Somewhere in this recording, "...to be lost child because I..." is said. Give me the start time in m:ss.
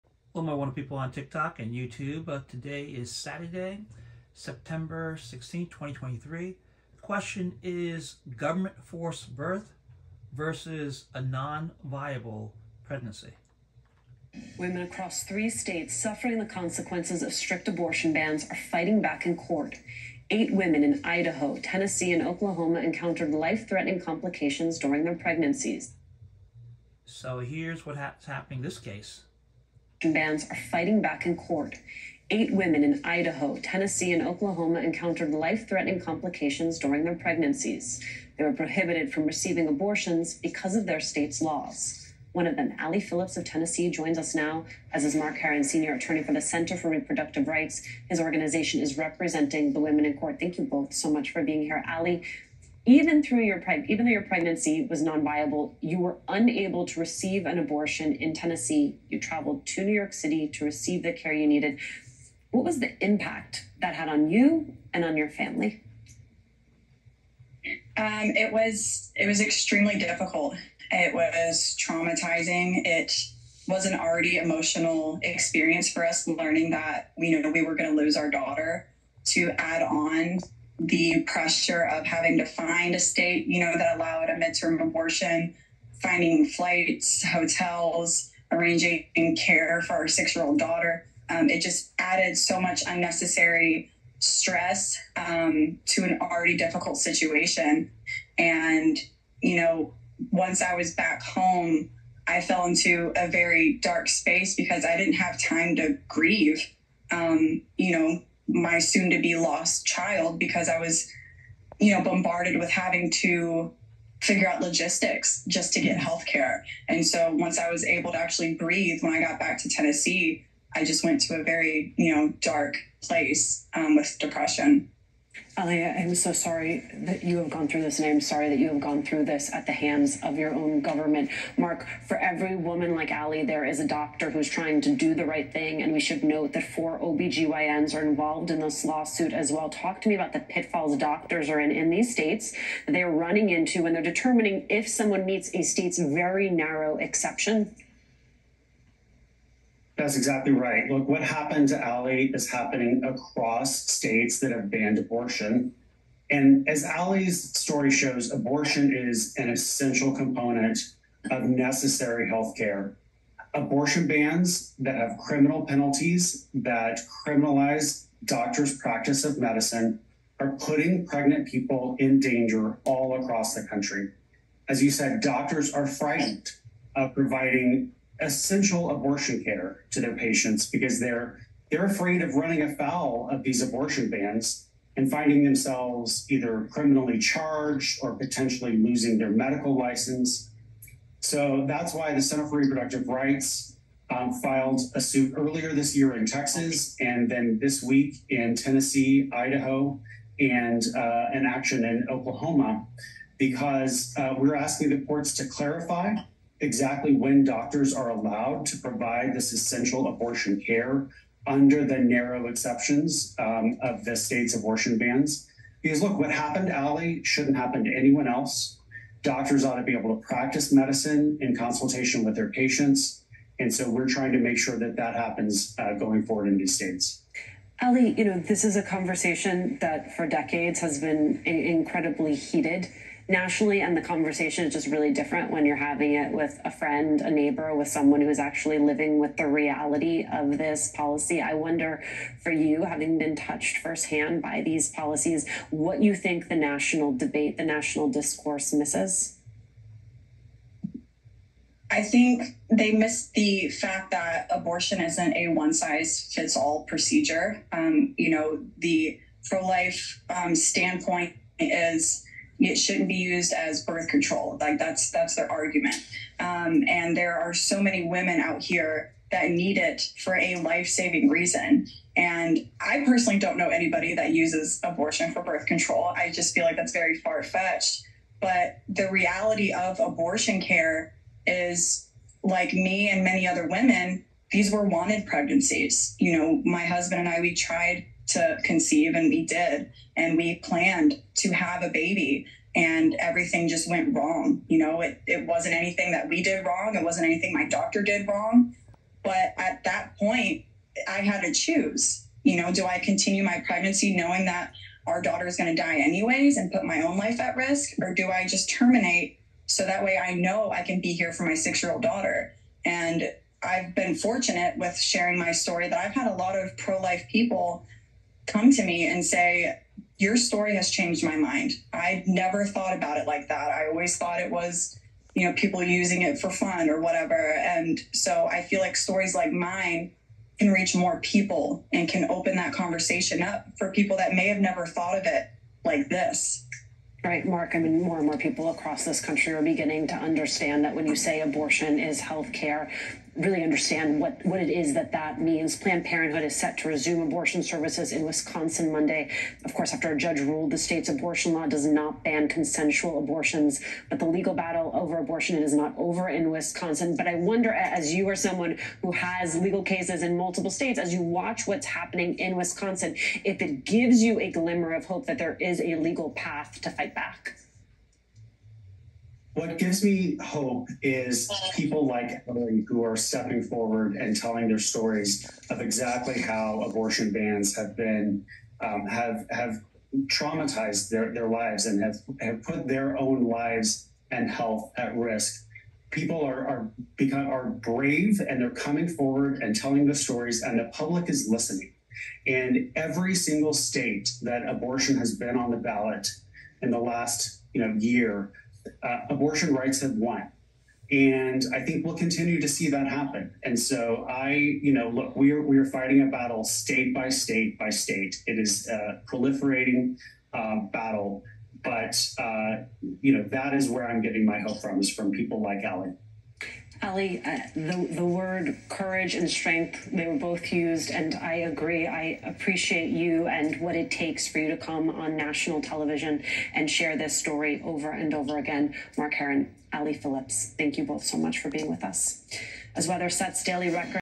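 1:49.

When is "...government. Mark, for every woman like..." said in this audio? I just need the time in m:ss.
2:10.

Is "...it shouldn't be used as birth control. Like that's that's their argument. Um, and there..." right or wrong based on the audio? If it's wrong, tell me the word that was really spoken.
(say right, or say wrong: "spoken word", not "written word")
right.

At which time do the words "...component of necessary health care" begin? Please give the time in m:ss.
2:40.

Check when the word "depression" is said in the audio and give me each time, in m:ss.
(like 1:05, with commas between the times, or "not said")
2:04.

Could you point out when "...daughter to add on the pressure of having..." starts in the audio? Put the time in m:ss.
1:18.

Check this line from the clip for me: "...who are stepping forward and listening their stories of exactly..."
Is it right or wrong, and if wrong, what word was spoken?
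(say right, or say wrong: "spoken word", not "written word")
wrong: "telling", not "listening".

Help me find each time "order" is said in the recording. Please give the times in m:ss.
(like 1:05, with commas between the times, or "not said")
not said.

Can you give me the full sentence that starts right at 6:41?
And I think we'll continue to see that happen.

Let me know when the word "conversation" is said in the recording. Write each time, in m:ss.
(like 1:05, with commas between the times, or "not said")
3:48, 3:54, 5:32.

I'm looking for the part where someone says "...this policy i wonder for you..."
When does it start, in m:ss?
4:00.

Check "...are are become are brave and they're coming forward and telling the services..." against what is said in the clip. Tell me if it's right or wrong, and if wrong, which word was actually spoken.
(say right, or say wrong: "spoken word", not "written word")
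wrong: "stories", not "services".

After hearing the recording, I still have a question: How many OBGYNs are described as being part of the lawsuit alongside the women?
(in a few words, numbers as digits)
4.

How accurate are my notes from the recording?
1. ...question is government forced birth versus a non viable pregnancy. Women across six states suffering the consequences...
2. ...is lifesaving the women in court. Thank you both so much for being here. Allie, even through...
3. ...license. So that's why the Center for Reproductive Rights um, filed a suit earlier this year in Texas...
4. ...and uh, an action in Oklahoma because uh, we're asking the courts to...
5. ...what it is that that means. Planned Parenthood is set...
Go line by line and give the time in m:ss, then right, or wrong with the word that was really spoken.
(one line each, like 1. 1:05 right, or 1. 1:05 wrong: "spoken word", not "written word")
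1. 0:07 wrong: "three", not "six"
2. 0:48 wrong: "representing", not "lifesaving"
3. 3:09 right
4. 3:20 right
5. 5:44 right.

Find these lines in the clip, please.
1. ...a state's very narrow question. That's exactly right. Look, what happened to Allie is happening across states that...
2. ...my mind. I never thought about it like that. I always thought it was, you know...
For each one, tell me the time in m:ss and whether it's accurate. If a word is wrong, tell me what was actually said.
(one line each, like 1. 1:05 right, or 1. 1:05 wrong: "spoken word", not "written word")
1. 2:25 wrong: "exception", not "question"
2. 5:21 right.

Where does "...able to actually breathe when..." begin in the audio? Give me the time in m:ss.
1:57.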